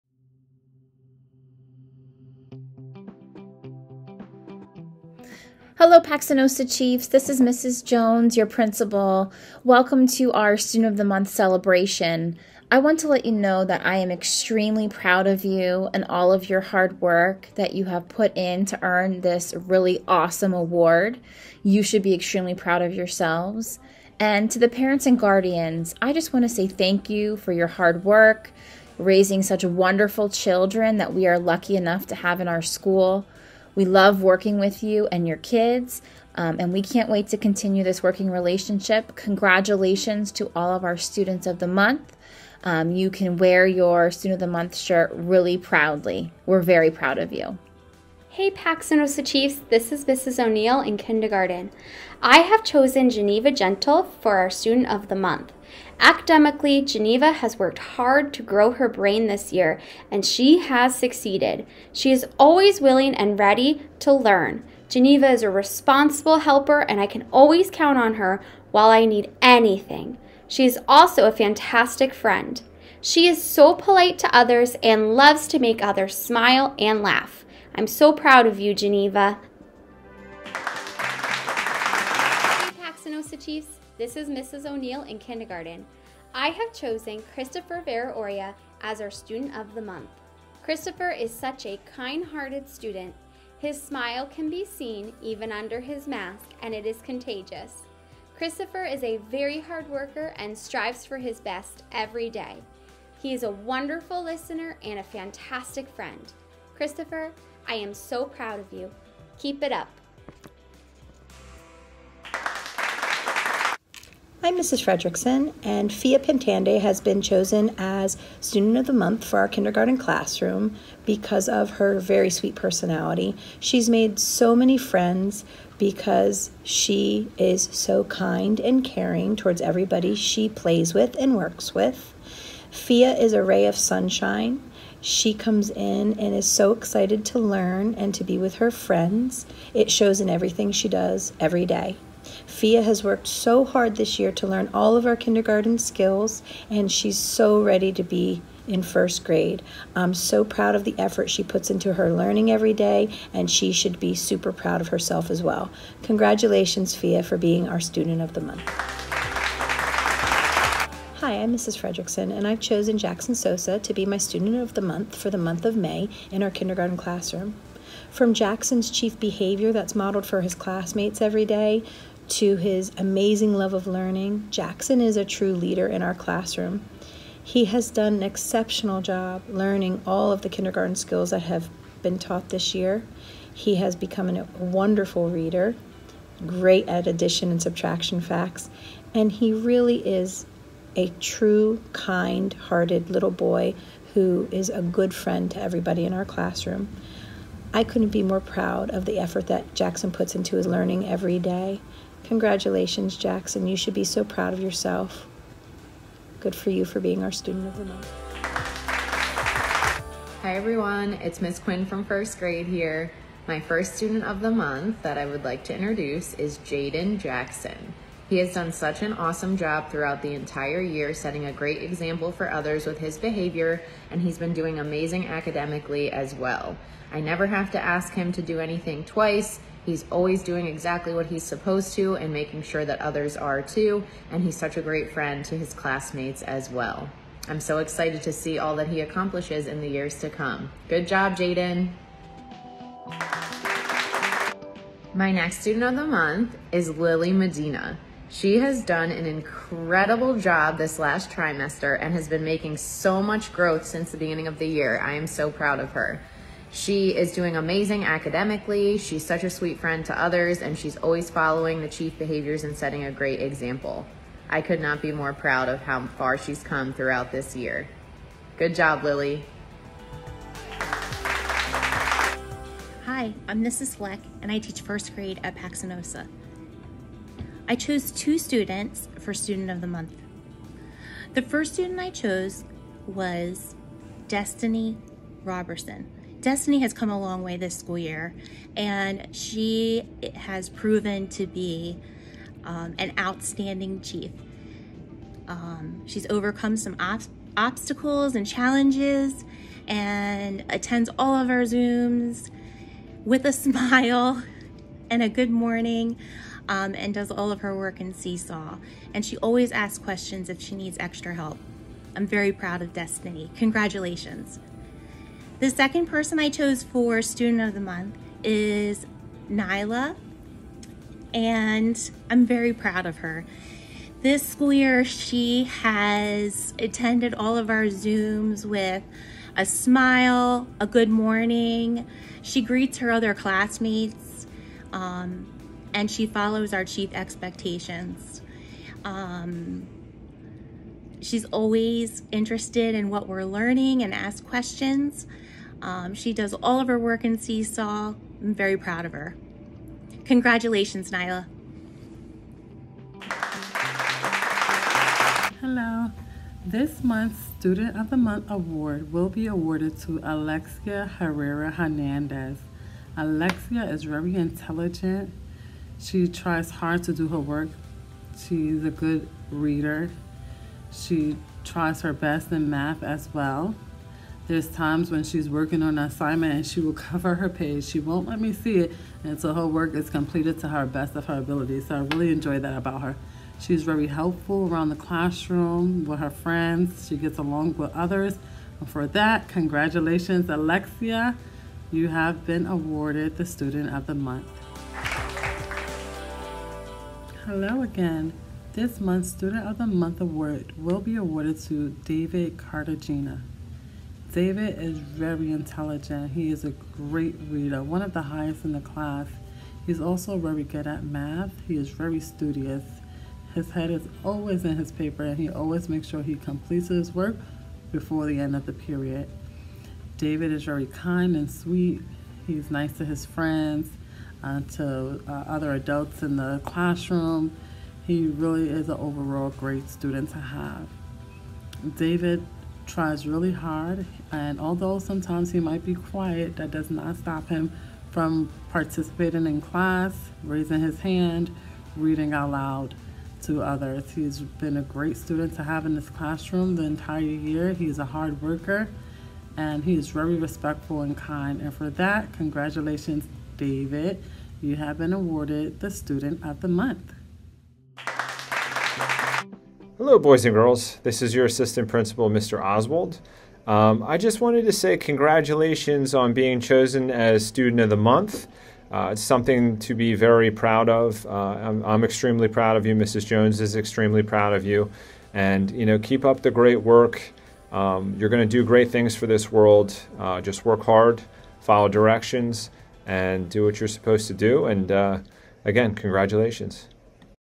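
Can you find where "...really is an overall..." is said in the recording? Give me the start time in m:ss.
7:08.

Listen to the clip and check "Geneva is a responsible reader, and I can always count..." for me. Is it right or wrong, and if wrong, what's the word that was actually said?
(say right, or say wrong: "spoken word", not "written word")
wrong: "helper", not "reader".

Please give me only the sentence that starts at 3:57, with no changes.
I'm so excited to see all that he accomplishes in the years to come.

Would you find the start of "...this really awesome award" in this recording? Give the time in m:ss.
0:19.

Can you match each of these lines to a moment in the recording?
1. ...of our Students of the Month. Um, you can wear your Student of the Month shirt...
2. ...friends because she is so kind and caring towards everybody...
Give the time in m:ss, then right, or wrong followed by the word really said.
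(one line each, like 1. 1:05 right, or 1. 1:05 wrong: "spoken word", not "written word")
1. 0:40 right
2. 2:04 right.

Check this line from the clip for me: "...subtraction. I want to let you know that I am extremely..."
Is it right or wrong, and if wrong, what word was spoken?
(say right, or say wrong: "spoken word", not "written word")
wrong: "celebration", not "subtraction".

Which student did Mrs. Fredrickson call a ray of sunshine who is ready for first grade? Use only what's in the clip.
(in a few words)
Fia Pintande.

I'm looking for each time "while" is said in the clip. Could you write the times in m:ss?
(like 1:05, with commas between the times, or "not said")
1:08.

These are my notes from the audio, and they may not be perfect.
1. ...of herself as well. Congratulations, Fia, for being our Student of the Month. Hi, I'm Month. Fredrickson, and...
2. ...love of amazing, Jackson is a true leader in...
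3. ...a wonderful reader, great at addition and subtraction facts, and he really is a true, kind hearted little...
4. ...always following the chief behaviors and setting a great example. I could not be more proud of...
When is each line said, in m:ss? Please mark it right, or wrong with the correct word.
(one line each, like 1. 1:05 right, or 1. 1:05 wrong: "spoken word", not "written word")
1. 2:34 wrong: "Mrs", not "Month"
2. 2:53 wrong: "learning", not "amazing"
3. 3:04 right
4. 4:20 right.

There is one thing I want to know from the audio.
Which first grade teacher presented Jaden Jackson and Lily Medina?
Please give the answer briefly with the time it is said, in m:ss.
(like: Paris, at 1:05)
Miss Quinn, at 3:31.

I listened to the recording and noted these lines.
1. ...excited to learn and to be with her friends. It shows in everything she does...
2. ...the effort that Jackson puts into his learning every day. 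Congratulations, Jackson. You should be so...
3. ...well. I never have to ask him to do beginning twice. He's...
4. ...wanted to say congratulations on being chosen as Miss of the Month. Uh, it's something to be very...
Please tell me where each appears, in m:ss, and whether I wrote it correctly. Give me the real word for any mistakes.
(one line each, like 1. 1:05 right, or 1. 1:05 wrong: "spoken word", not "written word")
1. 2:16 right
2. 3:19 right
3. 3:46 wrong: "anything", not "beginning"
4. 7:44 wrong: "Student", not "Miss".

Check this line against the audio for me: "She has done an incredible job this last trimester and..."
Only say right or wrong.
right.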